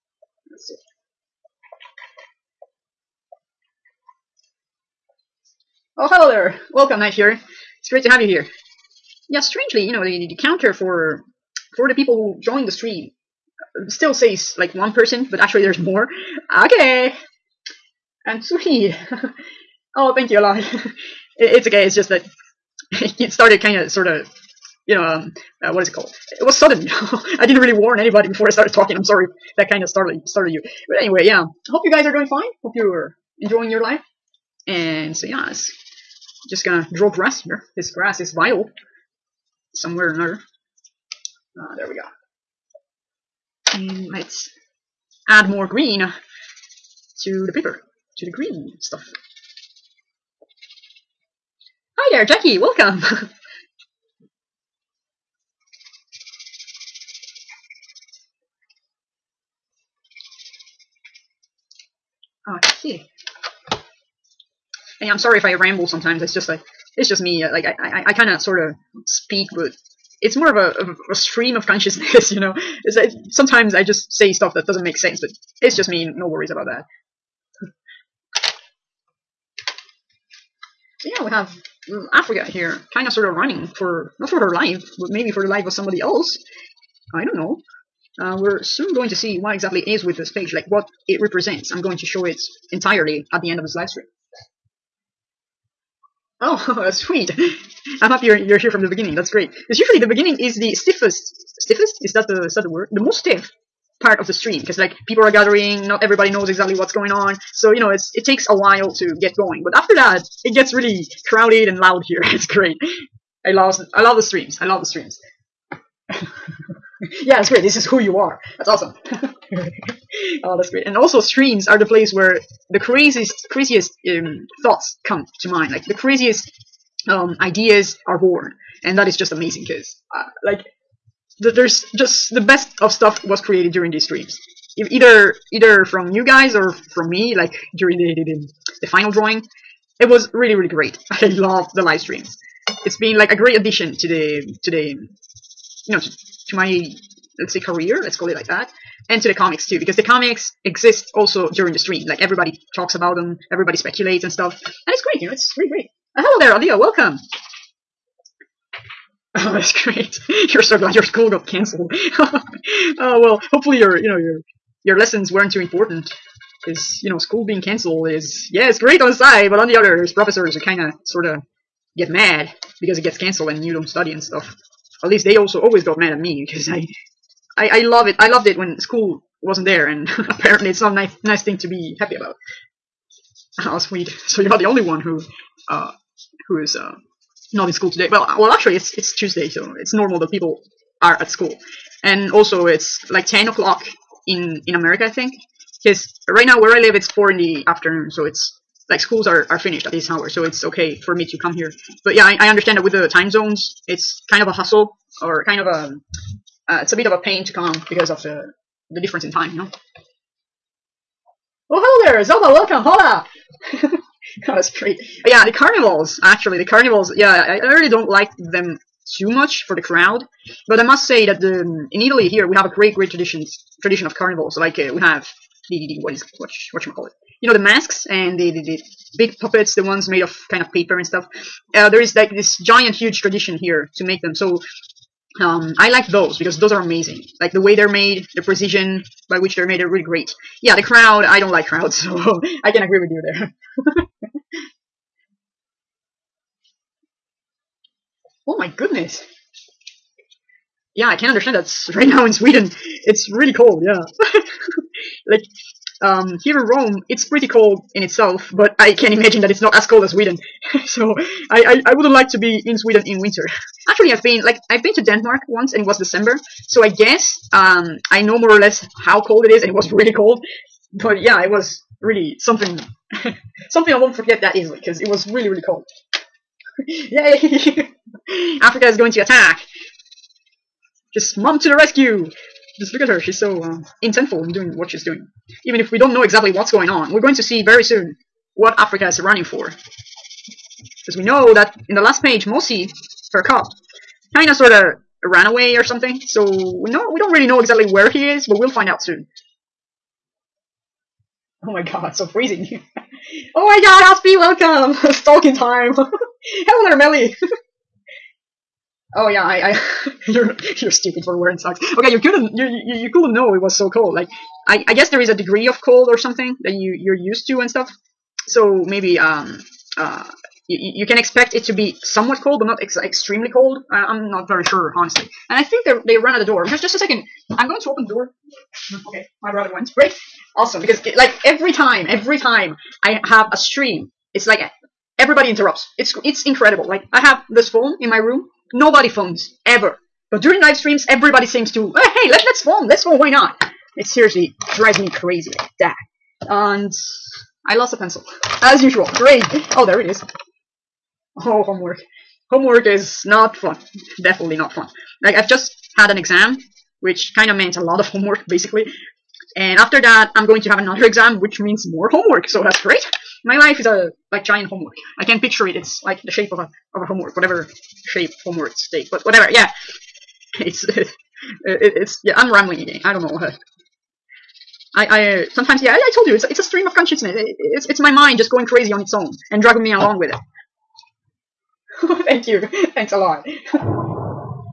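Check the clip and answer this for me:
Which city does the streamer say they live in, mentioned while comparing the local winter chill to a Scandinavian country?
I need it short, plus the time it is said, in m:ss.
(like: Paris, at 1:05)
Rome, at 4:16.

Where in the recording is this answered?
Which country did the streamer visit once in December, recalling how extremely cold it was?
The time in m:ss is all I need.
4:25.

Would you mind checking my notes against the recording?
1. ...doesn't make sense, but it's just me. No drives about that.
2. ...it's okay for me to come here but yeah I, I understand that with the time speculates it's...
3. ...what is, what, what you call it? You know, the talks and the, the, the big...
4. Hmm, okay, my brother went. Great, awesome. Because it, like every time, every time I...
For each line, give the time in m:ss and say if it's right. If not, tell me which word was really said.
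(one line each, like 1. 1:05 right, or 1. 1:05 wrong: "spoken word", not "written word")
1. 1:14 wrong: "worries", not "drives"
2. 3:20 wrong: "zones", not "speculates"
3. 3:46 wrong: "masks", not "talks"
4. 5:28 right.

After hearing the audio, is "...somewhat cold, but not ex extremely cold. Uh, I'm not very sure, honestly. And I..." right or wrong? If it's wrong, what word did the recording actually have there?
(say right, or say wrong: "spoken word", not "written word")
right.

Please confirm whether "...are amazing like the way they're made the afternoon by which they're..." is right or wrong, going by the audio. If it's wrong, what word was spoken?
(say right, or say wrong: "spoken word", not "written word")
wrong: "precision", not "afternoon".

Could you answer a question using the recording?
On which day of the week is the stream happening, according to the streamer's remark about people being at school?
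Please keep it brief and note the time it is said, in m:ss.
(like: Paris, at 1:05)
Tuesday, at 3:09.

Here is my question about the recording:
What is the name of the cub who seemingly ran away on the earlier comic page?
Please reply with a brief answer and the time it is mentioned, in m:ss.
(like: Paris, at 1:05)
Mosi, at 4:52.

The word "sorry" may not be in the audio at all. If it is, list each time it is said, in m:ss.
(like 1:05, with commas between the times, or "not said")
0:29, 1:05.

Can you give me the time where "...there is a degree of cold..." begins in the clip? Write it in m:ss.
5:15.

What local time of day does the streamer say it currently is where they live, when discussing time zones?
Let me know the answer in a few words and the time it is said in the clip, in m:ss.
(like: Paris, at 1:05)
4 in the afternoon, at 3:17.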